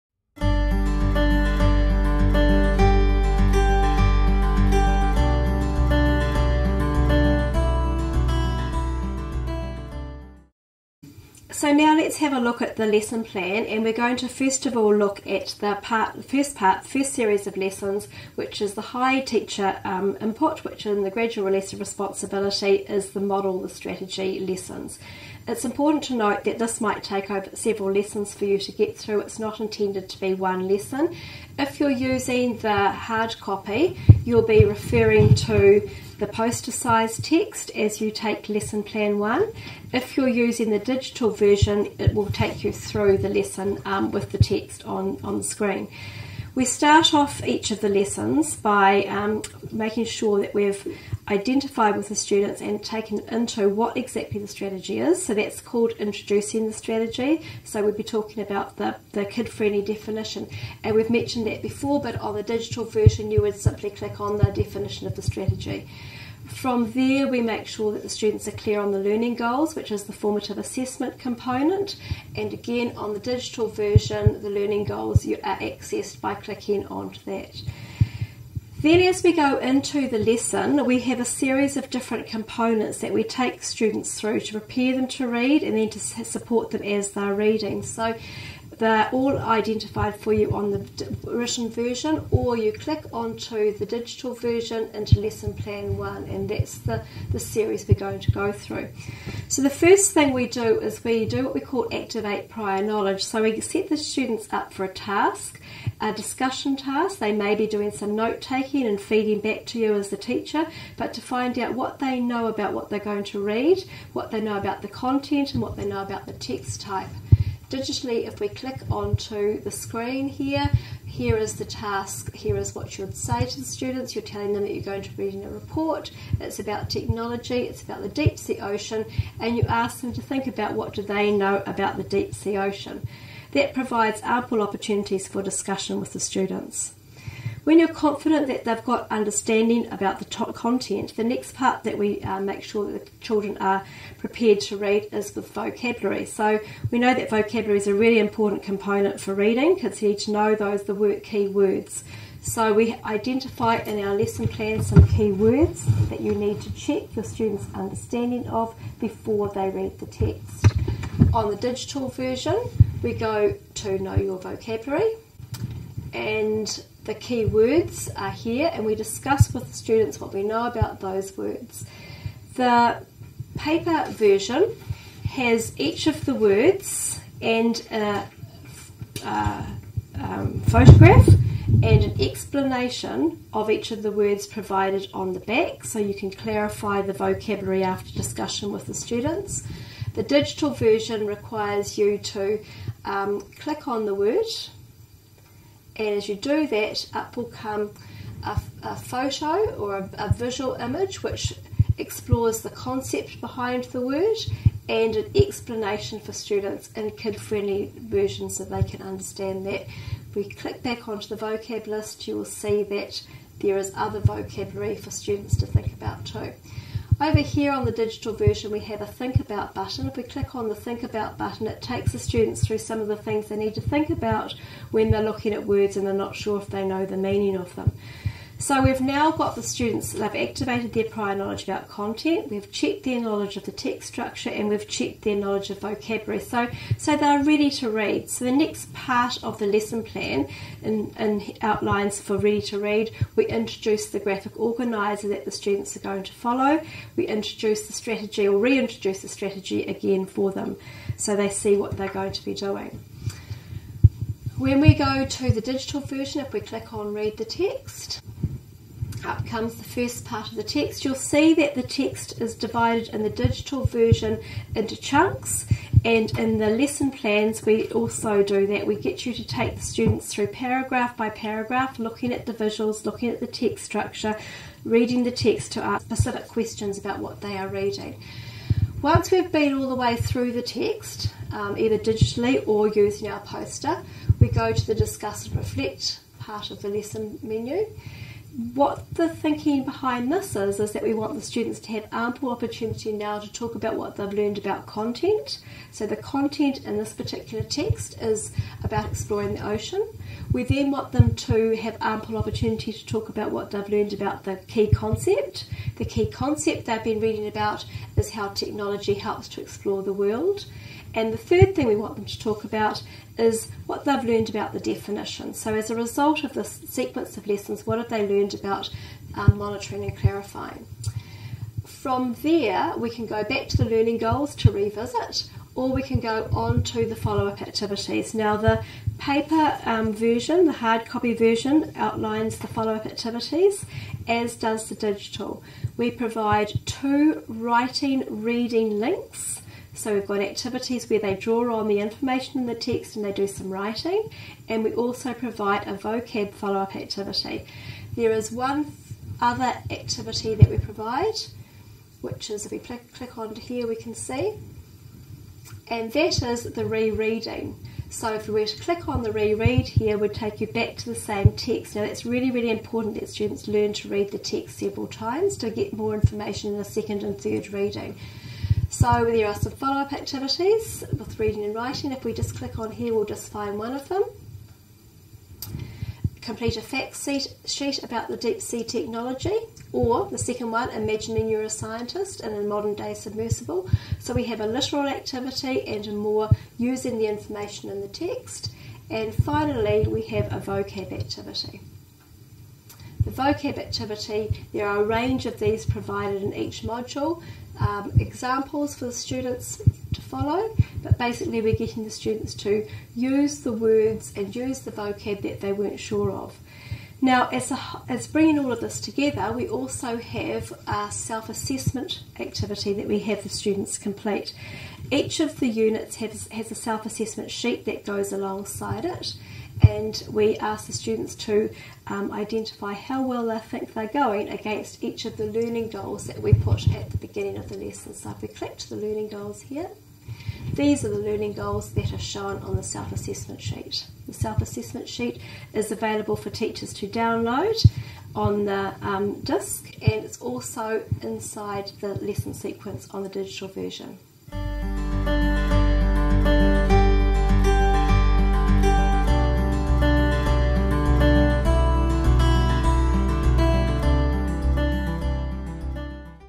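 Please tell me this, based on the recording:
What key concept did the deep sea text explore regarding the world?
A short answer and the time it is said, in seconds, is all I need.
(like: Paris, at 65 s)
how technology helps to explore the world, at 308 s.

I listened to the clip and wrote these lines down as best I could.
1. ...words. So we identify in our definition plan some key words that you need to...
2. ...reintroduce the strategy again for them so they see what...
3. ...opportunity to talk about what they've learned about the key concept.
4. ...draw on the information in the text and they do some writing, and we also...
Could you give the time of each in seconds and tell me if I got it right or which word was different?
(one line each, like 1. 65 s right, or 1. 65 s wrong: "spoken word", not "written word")
1. 151 s wrong: "lesson", not "definition"
2. 248 s right
3. 302 s right
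4. 341 s right.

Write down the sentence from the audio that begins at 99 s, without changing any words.
So, the first thing we do is we do what we call activate prior knowledge.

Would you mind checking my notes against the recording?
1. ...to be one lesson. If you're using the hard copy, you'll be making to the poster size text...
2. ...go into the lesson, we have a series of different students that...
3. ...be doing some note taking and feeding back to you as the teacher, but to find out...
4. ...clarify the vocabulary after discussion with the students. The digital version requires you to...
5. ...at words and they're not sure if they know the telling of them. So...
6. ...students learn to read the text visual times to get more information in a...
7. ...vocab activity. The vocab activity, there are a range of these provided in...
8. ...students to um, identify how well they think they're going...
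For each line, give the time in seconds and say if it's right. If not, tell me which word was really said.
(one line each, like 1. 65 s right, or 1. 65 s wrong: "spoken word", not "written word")
1. 30 s wrong: "referring", not "making"
2. 79 s wrong: "components", not "students"
3. 107 s right
4. 186 s right
5. 225 s wrong: "meaning", not "telling"
6. 363 s wrong: "several", not "visual"
7. 390 s right
8. 420 s right.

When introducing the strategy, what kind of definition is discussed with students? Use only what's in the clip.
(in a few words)
kid friendly definition.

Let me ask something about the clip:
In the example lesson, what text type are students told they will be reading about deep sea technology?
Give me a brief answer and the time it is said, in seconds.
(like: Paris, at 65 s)
a report, at 125 s.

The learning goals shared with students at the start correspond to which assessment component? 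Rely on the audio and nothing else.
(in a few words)
formative assessment.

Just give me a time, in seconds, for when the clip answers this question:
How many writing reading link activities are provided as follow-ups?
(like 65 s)
336 s.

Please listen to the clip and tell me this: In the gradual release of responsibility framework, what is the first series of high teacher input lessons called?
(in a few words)
the model.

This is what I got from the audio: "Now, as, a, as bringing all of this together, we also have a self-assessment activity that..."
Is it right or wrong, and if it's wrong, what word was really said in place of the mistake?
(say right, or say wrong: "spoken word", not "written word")
right.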